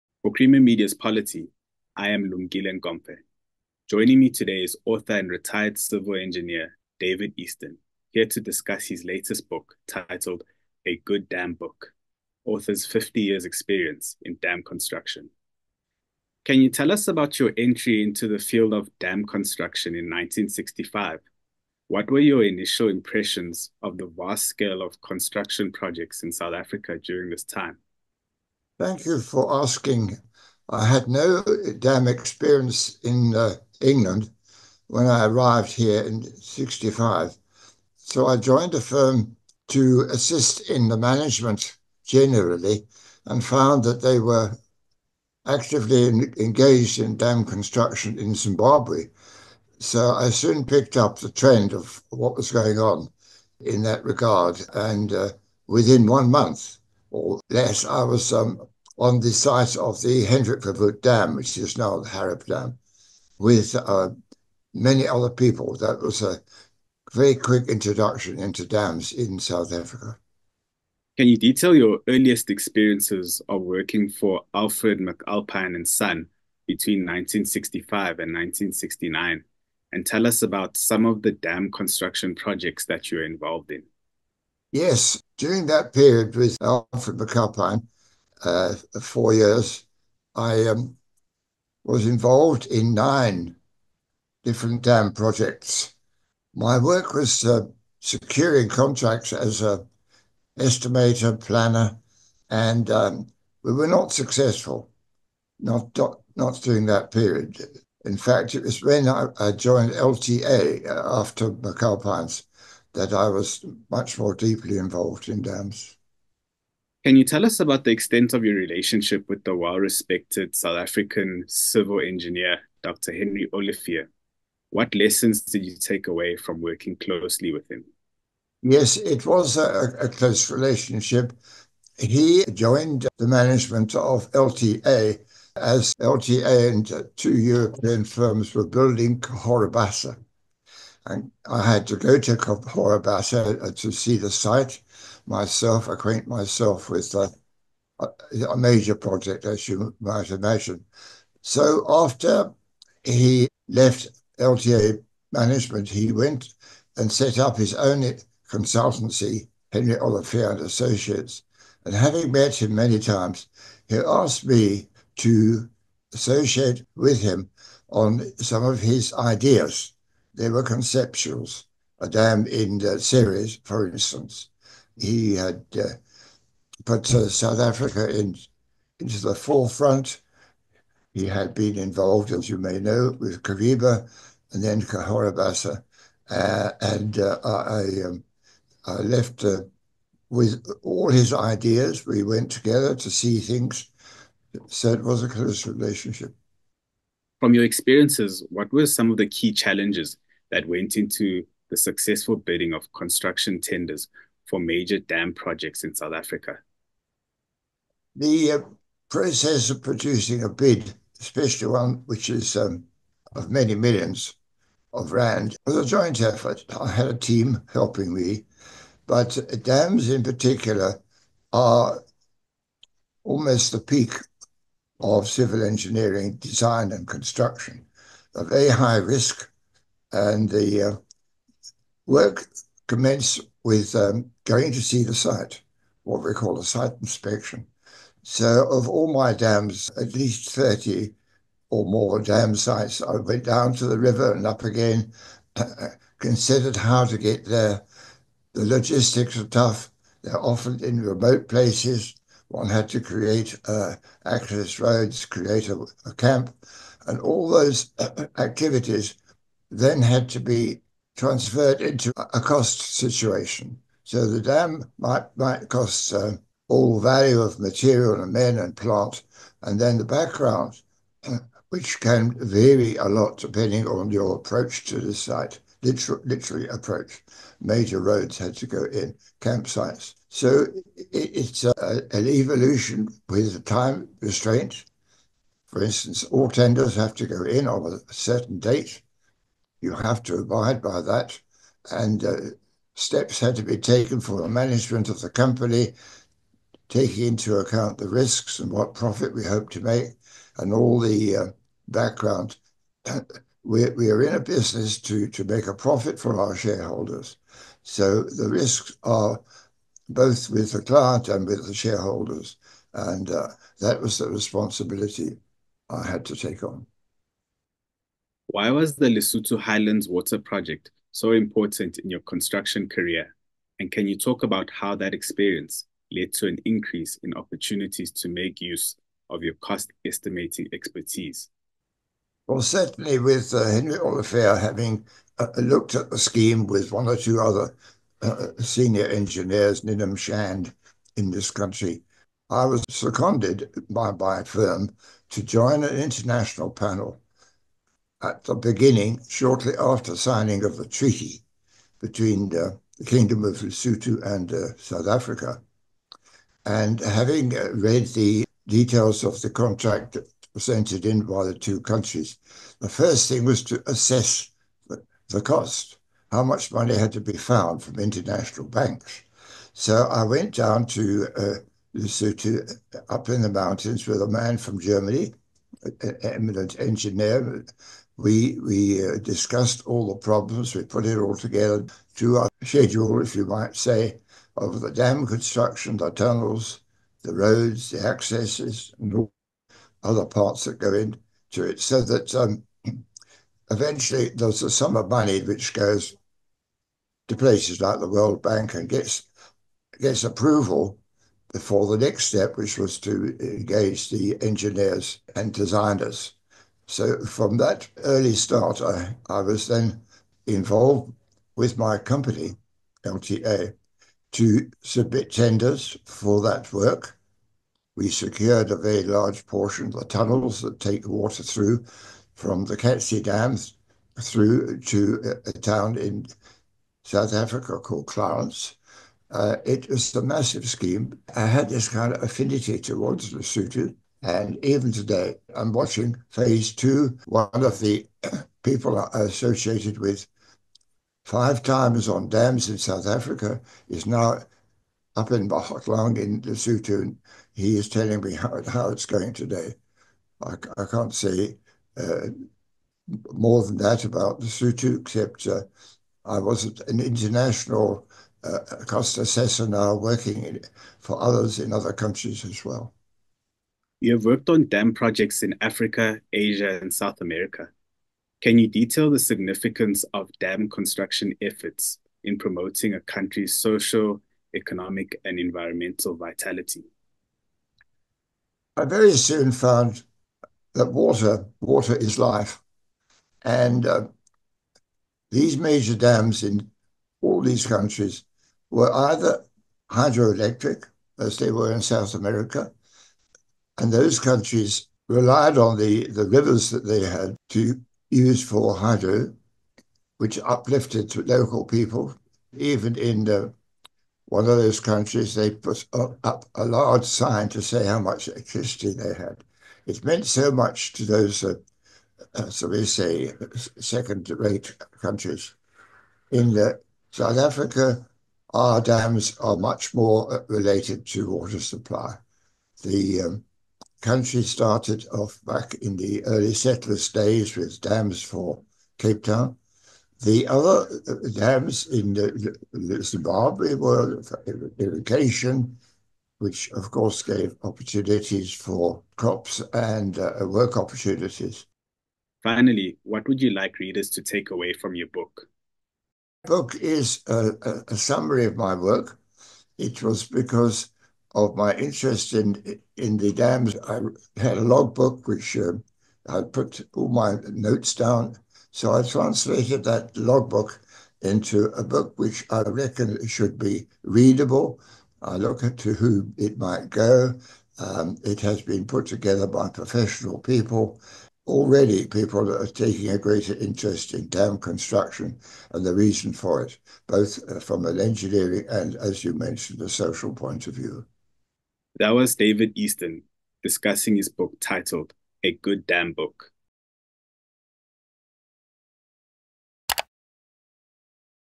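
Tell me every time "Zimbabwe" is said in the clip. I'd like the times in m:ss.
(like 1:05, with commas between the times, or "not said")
0:48, 8:53.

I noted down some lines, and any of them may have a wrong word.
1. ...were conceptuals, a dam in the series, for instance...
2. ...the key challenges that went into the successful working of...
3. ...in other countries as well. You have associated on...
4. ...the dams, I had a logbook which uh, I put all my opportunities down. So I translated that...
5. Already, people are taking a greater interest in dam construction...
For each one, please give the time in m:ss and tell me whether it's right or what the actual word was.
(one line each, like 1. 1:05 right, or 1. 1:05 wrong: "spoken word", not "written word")
1. 2:50 right
2. 3:19 wrong: "bidding", not "working"
3. 7:41 wrong: "worked", not "associated"
4. 9:13 wrong: "notes", not "opportunities"
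5. 9:31 right.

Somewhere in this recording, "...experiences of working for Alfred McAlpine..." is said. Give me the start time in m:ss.
1:12.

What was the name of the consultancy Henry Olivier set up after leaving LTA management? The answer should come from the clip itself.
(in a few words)
Henry Olivier and Associates.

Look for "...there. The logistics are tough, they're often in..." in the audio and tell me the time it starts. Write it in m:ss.
4:07.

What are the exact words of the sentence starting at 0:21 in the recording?
What were your initial impressions of the vast scale of construction projects in South Africa during this time?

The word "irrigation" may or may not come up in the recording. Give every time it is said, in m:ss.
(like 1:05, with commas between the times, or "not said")
8:54.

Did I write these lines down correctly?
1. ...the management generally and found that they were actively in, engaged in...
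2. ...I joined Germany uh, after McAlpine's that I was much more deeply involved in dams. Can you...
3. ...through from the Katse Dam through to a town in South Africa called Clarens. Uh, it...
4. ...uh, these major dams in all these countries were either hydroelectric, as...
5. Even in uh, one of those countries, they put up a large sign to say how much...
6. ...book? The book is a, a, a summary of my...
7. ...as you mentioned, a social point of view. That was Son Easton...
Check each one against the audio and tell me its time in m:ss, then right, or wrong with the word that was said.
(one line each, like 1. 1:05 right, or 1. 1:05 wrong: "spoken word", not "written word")
1. 0:40 right
2. 1:49 wrong: "LTA", not "Germany"
3. 7:01 right
4. 8:03 right
5. 8:22 right
6. 9:05 right
7. 9:38 wrong: "David", not "Son".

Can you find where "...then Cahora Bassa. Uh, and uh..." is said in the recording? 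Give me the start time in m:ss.
3:04.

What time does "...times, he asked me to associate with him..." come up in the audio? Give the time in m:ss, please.
2:42.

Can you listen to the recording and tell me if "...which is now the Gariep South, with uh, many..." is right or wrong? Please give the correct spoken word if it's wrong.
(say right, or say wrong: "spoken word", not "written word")
wrong: "Dam", not "South".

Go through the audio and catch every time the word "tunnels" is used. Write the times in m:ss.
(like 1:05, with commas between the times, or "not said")
6:26, 7:00.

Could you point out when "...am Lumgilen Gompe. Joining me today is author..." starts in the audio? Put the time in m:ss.
0:02.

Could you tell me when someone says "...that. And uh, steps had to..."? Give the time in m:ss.
4:51.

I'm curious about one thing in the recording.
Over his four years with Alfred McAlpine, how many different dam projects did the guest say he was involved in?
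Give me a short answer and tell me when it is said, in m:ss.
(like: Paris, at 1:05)
9, at 1:32.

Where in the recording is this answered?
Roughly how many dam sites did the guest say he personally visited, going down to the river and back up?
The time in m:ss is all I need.
4:00.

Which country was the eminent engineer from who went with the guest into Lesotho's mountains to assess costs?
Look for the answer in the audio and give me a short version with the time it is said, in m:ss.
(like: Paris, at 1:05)
Germany, at 6:14.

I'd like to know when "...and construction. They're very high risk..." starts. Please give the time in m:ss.
3:46.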